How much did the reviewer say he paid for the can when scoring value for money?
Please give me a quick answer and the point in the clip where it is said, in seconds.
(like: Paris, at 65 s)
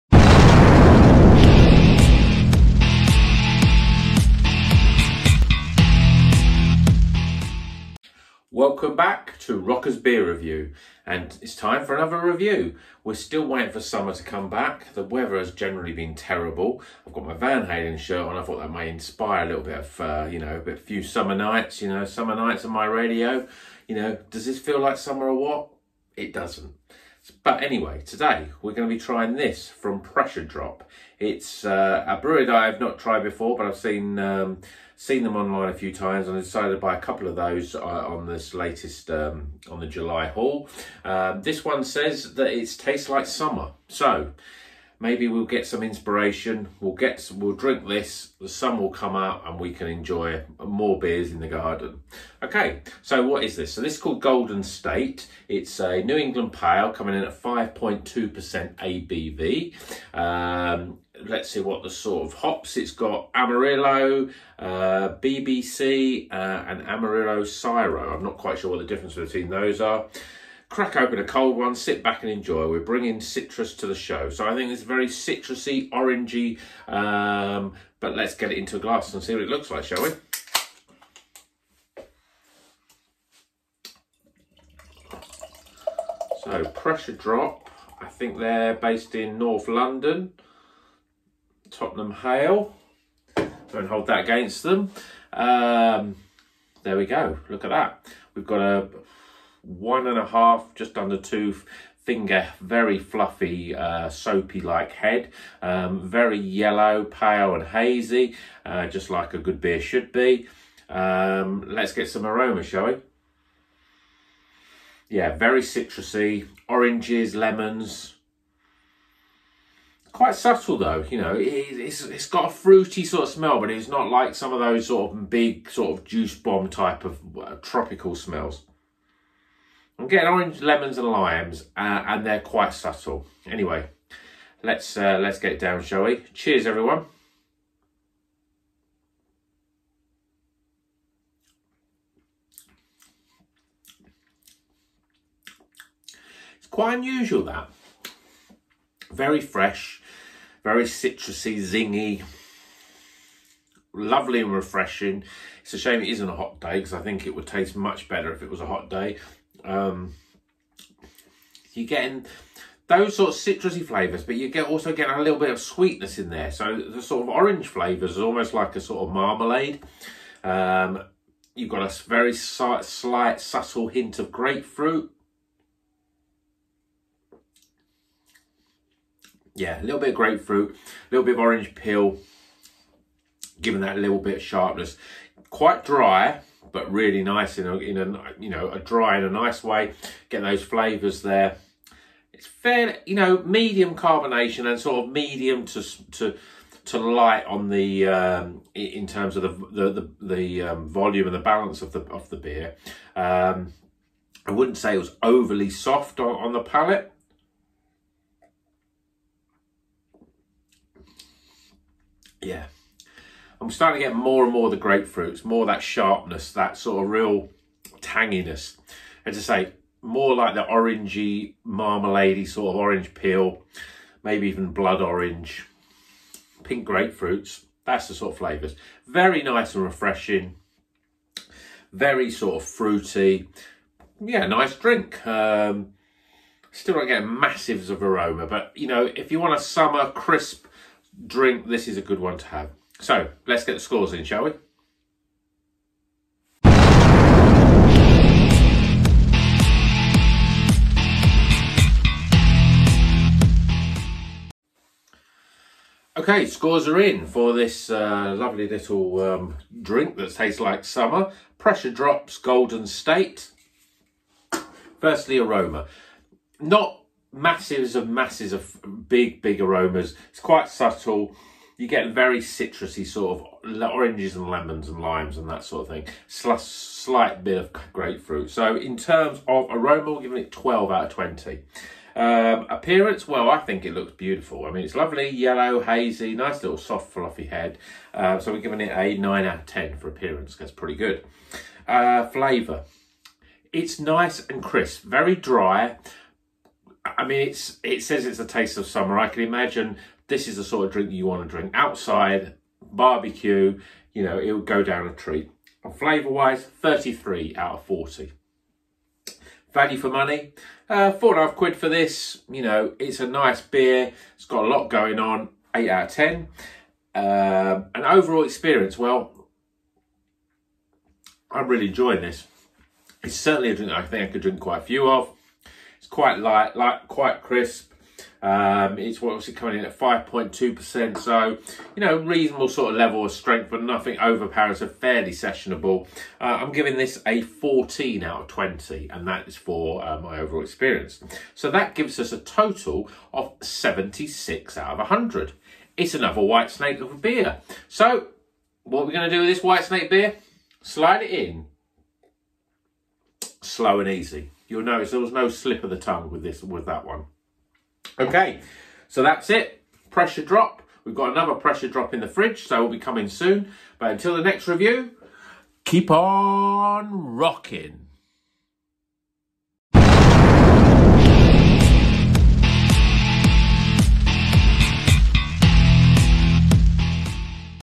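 four and a half quid, at 311 s.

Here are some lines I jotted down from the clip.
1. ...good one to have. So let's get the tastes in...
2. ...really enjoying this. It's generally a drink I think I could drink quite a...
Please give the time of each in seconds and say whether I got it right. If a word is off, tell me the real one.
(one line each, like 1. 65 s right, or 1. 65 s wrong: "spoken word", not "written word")
1. 242 s wrong: "scores", not "tastes"
2. 321 s wrong: "certainly", not "generally".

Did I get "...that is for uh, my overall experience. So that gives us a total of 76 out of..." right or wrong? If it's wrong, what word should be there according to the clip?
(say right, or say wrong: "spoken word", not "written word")
right.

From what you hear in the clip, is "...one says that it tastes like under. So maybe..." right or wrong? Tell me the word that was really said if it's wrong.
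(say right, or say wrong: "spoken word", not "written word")
wrong: "summer", not "under".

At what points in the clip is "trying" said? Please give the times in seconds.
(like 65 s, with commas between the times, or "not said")
29 s.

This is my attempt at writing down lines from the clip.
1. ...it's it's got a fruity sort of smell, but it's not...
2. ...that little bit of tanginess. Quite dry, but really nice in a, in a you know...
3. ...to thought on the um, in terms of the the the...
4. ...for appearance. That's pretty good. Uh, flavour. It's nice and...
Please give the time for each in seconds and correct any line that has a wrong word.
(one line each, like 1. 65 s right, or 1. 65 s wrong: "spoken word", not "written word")
1. 121 s right
2. 183 s wrong: "sharpness", not "tanginess"
3. 196 s wrong: "light", not "thought"
4. 289 s right.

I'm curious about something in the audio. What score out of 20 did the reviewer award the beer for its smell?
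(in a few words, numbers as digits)
12.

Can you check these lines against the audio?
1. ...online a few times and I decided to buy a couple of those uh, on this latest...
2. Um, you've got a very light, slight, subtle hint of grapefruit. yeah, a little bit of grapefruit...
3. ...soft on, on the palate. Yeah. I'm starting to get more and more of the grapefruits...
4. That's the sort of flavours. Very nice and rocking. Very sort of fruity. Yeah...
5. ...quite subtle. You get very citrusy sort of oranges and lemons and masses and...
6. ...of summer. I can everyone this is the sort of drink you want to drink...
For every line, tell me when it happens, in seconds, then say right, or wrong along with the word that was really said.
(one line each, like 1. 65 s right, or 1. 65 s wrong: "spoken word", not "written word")
1. 35 s right
2. 170 s wrong: "slight", not "light"
3. 205 s right
4. 227 s wrong: "refreshing", not "rocking"
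5. 270 s wrong: "limes", not "masses"
6. 298 s wrong: "imagine", not "everyone".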